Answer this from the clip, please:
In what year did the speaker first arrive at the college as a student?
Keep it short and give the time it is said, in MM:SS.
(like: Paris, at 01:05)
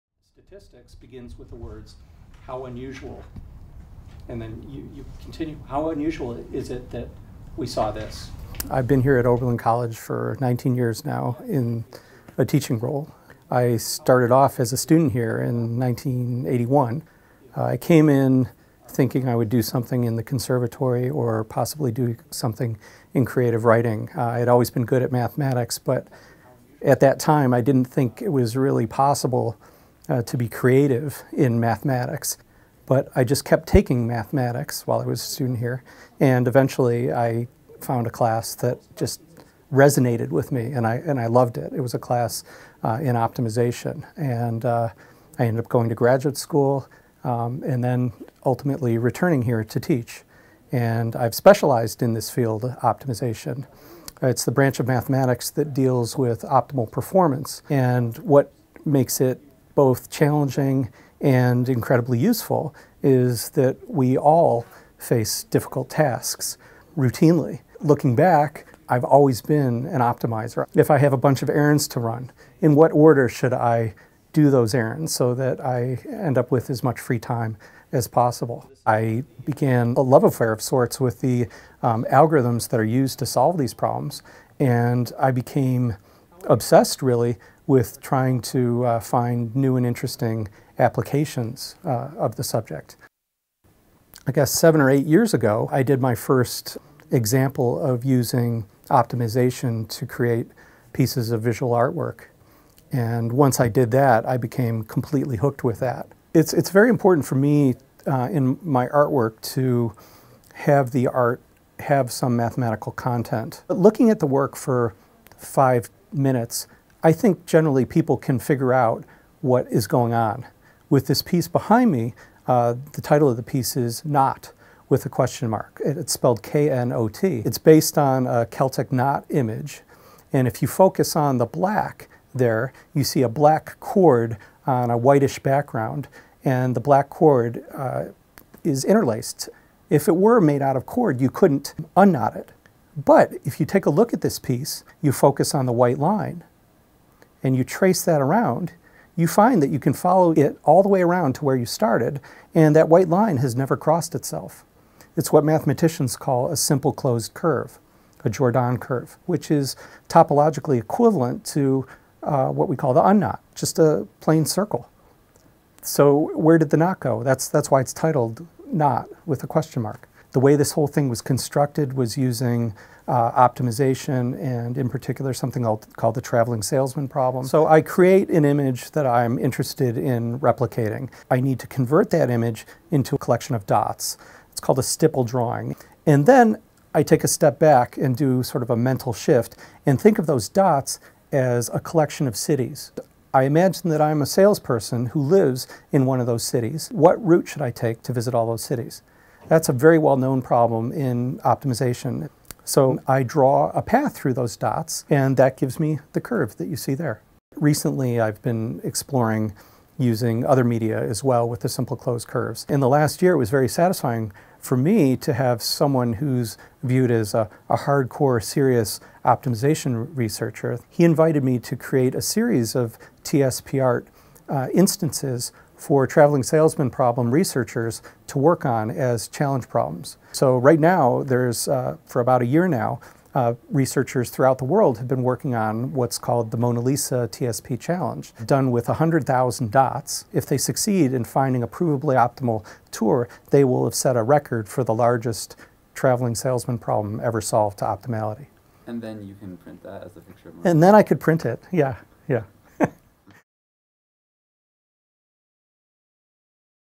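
1981, at 00:15.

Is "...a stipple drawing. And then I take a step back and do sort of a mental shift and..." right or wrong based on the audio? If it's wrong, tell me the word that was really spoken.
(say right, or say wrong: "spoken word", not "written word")
right.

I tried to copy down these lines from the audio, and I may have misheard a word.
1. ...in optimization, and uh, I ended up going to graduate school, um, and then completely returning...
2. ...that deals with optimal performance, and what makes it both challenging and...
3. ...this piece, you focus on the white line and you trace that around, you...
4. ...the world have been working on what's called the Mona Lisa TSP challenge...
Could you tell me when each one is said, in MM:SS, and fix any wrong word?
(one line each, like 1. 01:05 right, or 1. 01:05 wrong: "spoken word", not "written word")
1. 00:43 wrong: "ultimately", not "completely"
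2. 00:55 right
3. 02:24 right
4. 03:54 right.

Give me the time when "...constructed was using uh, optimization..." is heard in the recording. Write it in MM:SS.
02:51.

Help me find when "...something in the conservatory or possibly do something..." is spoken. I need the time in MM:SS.
00:19.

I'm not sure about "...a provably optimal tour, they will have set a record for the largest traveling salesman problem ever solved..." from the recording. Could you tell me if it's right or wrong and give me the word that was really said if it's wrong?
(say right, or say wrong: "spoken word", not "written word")
right.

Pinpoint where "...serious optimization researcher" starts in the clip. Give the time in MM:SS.
03:38.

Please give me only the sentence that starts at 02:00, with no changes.
With this piece behind me, uh, the title of the piece is Knot with a question mark.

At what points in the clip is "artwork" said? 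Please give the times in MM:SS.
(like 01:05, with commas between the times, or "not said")
01:41, 01:48.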